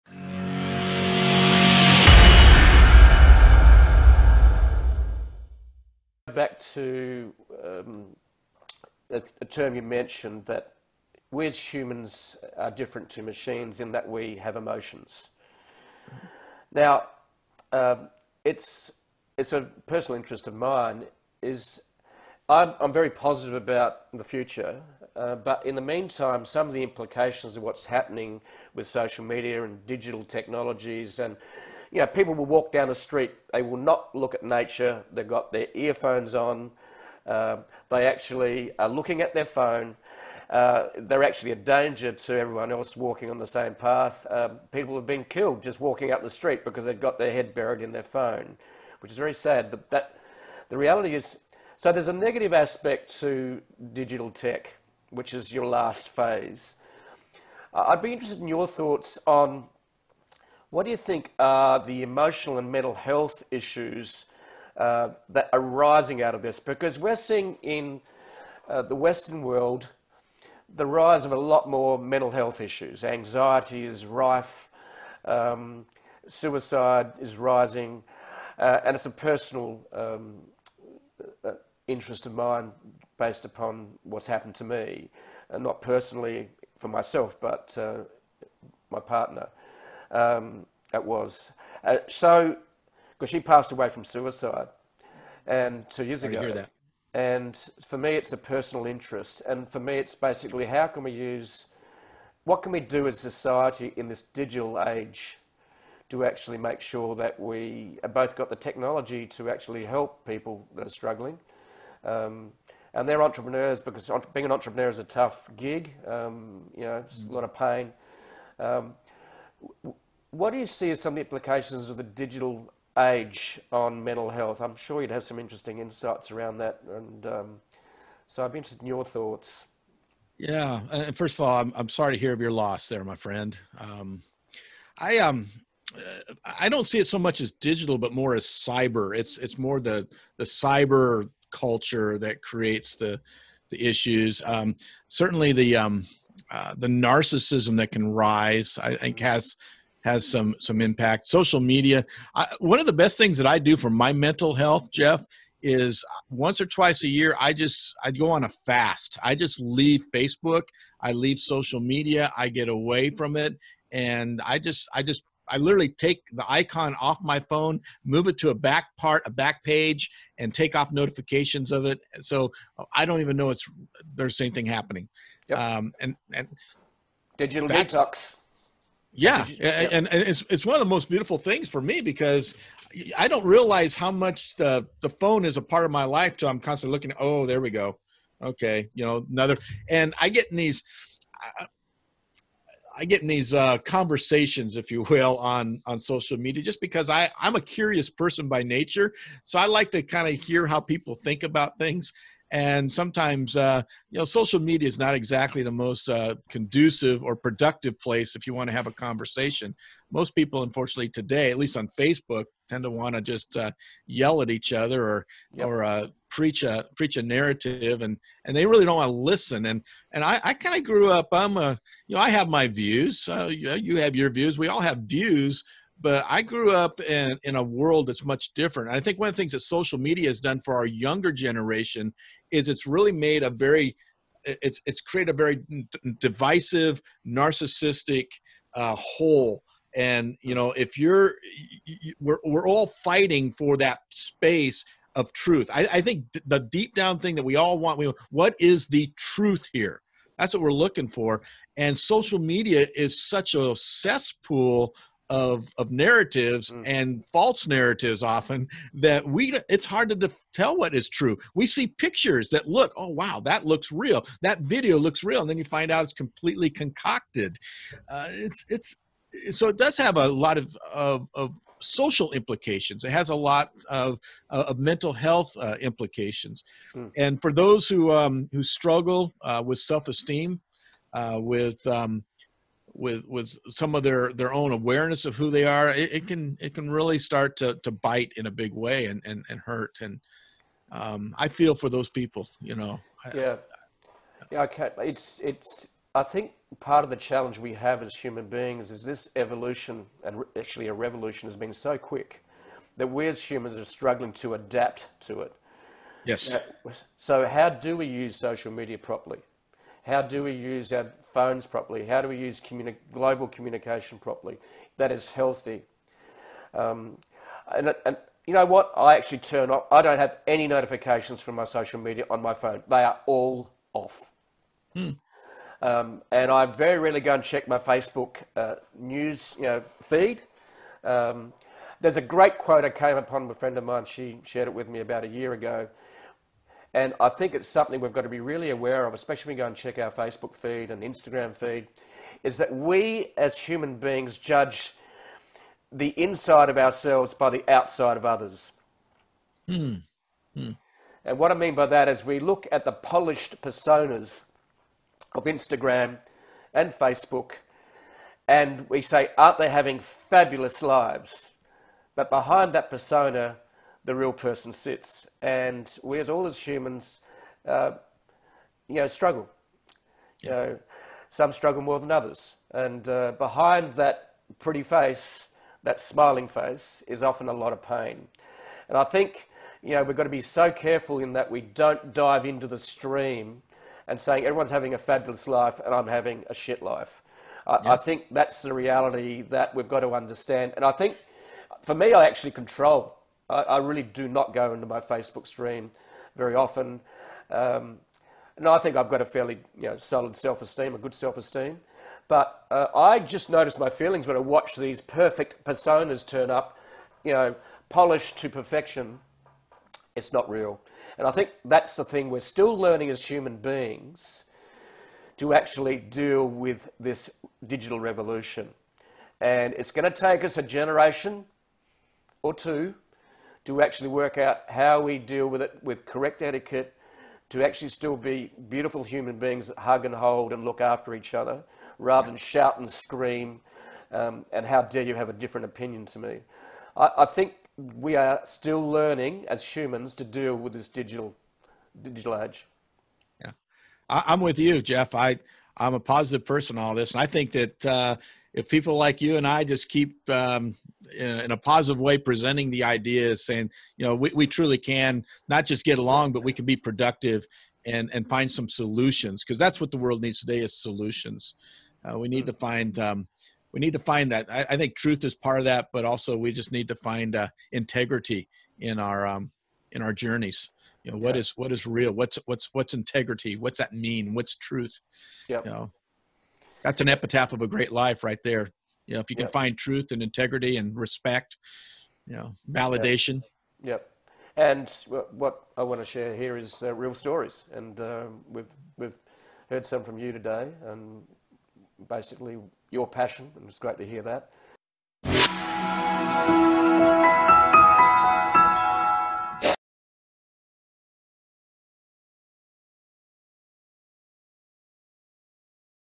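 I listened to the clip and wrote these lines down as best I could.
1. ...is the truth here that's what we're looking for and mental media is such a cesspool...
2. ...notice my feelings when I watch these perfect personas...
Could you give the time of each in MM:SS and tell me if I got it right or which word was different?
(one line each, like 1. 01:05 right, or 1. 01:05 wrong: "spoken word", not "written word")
1. 04:08 wrong: "social", not "mental"
2. 06:43 right.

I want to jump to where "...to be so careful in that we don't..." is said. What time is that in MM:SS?
06:20.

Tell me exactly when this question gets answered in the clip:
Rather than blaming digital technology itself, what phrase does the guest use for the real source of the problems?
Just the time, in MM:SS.
02:20.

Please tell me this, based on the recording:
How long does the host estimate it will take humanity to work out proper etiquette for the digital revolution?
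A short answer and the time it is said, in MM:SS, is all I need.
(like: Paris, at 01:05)
A generation or two, at 07:00.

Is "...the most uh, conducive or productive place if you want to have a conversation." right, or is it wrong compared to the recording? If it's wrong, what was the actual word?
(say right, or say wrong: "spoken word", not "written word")
right.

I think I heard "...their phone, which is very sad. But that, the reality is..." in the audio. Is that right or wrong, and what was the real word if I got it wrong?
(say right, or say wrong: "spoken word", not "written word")
right.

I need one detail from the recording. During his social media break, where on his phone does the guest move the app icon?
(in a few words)
A back page.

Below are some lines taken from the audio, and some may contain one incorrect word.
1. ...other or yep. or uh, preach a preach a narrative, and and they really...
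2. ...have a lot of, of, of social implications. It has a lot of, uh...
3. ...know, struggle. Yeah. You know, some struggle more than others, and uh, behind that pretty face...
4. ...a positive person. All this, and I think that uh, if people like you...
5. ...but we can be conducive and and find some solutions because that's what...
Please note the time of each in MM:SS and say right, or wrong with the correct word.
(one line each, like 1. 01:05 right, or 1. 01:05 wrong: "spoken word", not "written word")
1. 03:34 right
2. 04:29 right
3. 06:08 right
4. 07:25 right
5. 07:36 wrong: "productive", not "conducive".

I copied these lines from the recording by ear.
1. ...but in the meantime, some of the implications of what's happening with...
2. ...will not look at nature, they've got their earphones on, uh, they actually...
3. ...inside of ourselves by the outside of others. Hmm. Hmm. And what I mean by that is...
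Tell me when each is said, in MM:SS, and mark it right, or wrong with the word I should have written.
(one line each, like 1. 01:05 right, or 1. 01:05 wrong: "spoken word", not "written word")
1. 00:25 right
2. 00:33 right
3. 05:46 right.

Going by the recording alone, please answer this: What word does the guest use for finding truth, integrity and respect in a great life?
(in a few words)
An epitaph.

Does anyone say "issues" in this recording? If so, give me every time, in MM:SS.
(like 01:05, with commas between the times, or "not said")
01:03, 01:12, 02:23.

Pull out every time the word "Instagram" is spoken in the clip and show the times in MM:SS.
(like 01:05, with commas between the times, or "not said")
05:41, 05:55.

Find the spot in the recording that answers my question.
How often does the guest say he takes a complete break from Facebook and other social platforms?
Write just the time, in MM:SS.
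02:36.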